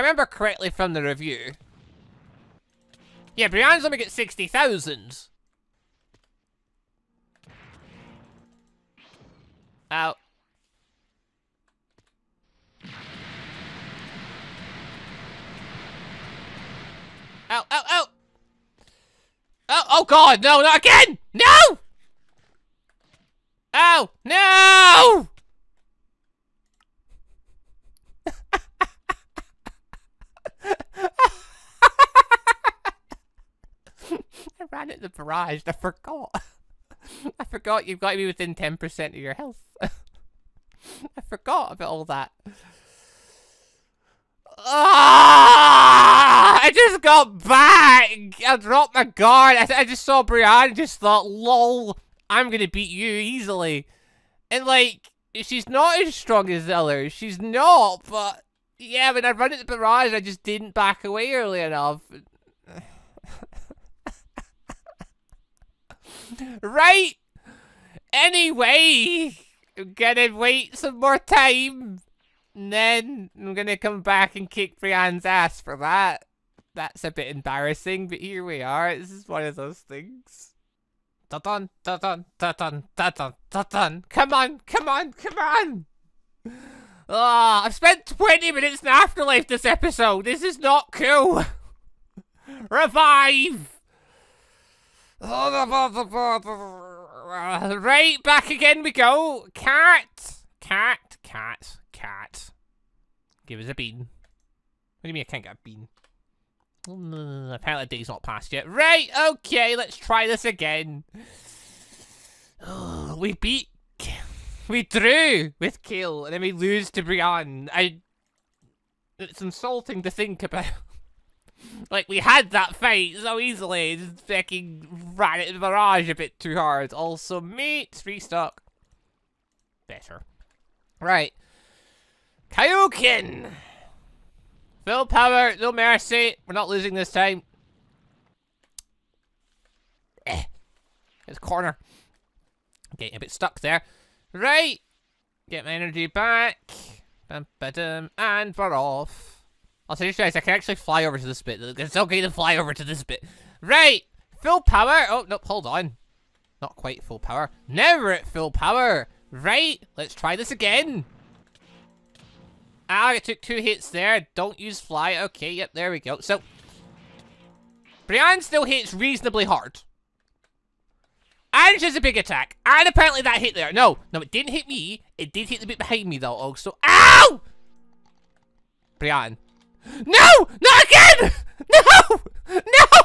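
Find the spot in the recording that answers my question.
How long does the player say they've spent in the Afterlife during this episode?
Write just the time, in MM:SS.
01:28.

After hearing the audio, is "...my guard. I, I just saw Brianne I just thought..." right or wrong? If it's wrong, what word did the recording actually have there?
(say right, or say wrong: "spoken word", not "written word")
right.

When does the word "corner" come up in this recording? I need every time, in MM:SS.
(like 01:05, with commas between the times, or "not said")
02:21.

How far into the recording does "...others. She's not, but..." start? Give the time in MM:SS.
00:56.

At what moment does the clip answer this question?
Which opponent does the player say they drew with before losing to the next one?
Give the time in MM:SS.
01:55.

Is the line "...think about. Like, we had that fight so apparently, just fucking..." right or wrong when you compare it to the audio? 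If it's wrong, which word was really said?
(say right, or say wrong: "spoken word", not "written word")
wrong: "easily", not "apparently".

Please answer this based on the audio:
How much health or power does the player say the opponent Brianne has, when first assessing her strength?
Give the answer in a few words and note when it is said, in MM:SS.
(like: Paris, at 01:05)
60,000, at 00:04.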